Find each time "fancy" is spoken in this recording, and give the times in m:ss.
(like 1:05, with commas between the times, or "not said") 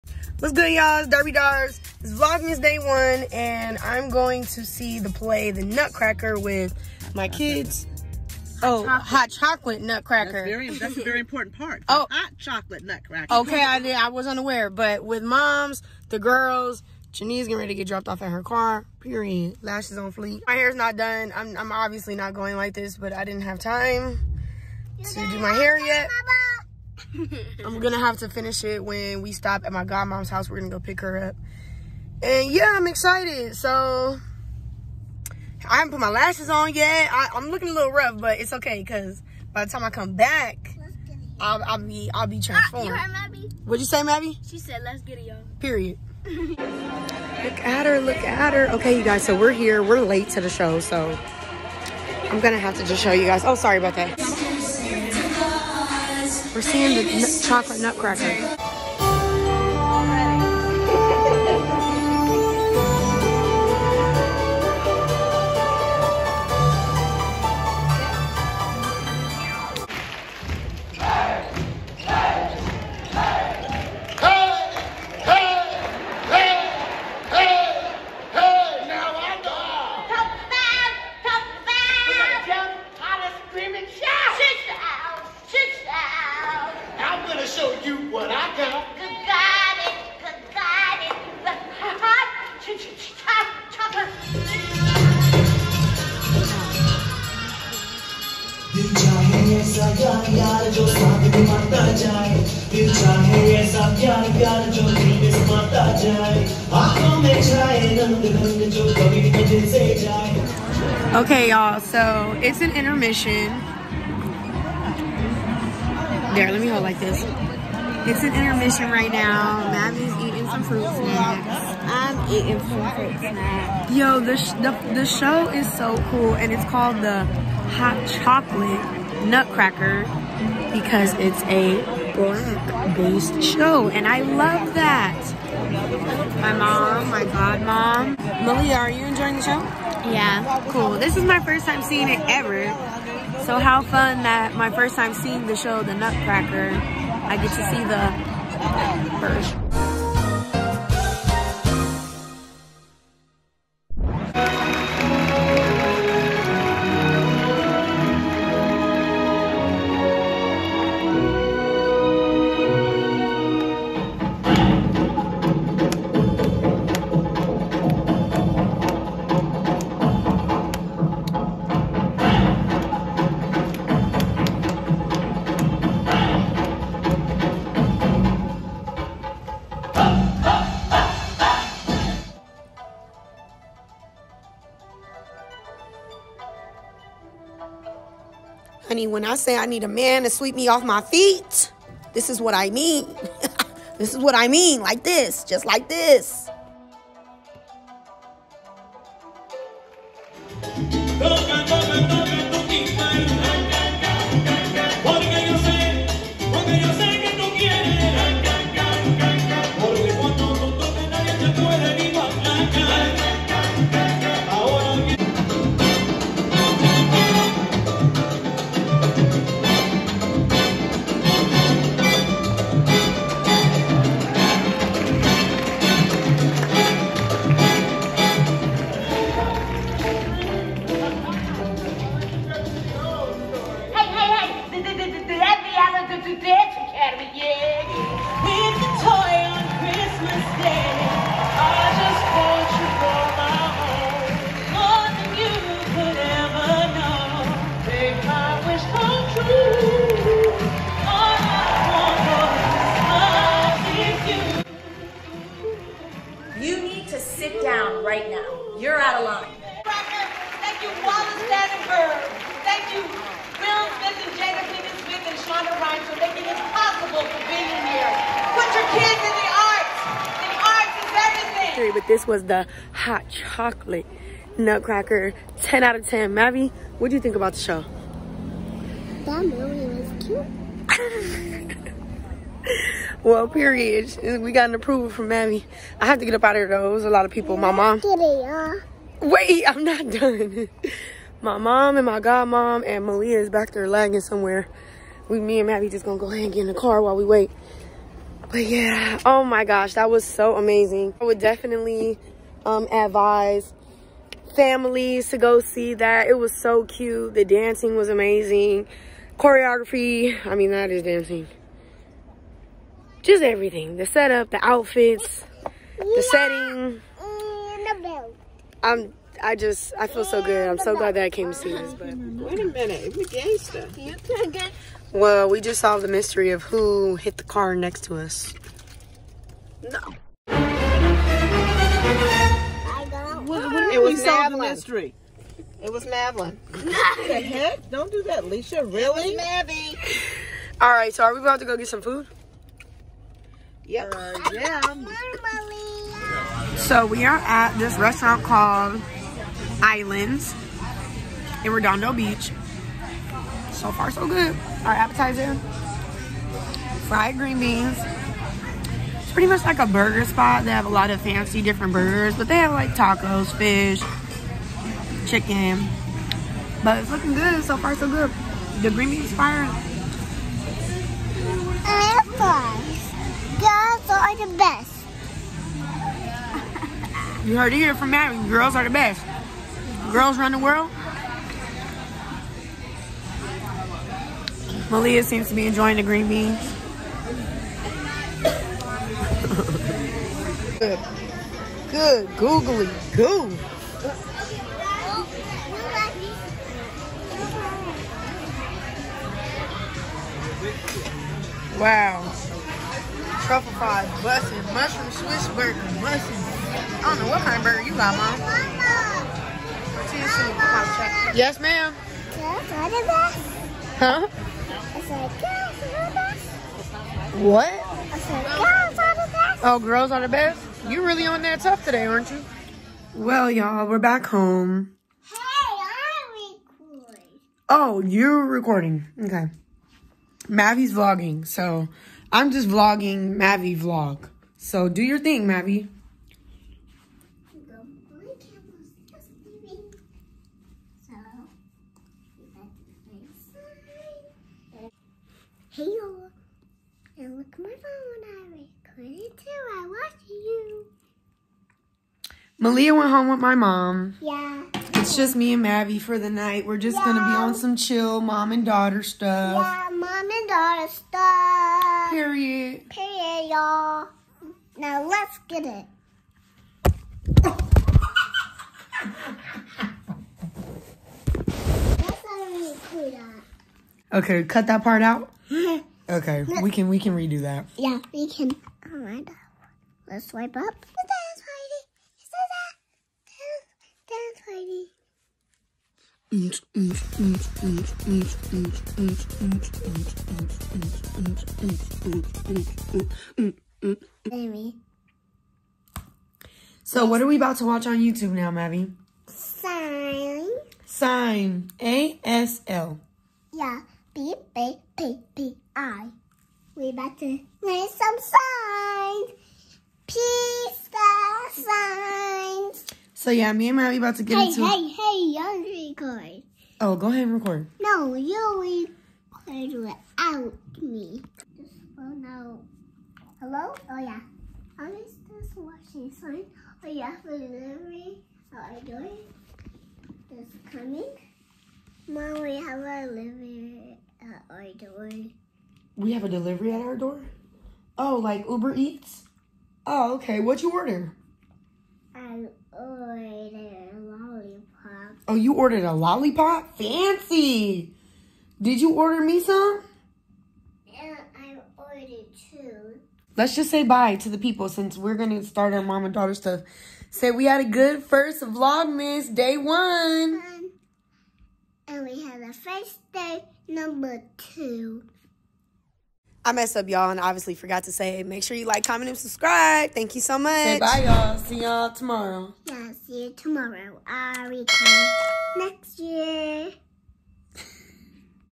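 6:01, 9:06.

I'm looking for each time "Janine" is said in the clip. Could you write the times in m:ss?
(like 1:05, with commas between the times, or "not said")
0:17.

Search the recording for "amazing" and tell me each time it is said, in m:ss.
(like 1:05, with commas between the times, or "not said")
5:00, 5:08.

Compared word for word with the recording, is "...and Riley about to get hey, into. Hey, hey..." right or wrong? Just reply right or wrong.
right.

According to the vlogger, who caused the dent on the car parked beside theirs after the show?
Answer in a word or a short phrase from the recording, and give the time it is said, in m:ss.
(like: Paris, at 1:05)
Madeline, at 5:36.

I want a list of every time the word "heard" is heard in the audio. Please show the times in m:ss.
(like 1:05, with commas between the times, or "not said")
0:42, 6:17.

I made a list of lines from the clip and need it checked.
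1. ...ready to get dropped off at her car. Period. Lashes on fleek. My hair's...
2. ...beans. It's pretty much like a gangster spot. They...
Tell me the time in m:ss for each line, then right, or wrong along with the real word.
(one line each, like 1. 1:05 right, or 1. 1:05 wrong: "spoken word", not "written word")
1. 0:17 right
2. 5:57 wrong: "burger", not "gangster".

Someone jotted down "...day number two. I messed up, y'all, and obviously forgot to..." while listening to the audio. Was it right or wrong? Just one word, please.
right.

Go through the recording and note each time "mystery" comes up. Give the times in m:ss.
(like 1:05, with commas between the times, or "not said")
5:26, 5:34.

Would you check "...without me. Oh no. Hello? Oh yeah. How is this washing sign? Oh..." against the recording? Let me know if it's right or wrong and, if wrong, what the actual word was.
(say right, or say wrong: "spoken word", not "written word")
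right.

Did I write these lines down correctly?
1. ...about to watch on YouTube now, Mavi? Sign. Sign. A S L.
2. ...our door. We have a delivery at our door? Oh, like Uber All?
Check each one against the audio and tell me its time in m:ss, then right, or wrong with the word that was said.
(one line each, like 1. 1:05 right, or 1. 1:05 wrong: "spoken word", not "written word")
1. 8:17 right
2. 8:54 wrong: "Eats", not "All".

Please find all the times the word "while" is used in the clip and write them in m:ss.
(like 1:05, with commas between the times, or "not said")
4:57.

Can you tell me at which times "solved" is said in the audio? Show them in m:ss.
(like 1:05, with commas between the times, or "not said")
5:25, 5:34.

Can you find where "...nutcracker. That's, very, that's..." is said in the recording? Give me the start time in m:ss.
0:09.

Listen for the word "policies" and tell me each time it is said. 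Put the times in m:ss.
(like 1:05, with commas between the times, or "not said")
not said.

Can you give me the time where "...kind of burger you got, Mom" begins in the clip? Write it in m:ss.
6:47.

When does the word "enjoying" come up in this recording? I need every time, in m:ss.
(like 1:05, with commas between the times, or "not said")
2:19, 6:25.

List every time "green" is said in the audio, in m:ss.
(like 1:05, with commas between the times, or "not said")
5:57, 6:08, 6:26.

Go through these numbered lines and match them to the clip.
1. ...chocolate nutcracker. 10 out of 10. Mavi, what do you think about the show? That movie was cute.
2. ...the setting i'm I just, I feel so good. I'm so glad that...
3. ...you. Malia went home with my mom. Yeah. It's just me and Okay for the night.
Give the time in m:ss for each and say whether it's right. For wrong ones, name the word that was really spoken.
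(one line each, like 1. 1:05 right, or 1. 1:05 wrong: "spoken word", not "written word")
1. 4:33 right
2. 5:15 right
3. 7:30 wrong: "Mavie", not "Okay".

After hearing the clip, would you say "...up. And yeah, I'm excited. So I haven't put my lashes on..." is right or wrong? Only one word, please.
right.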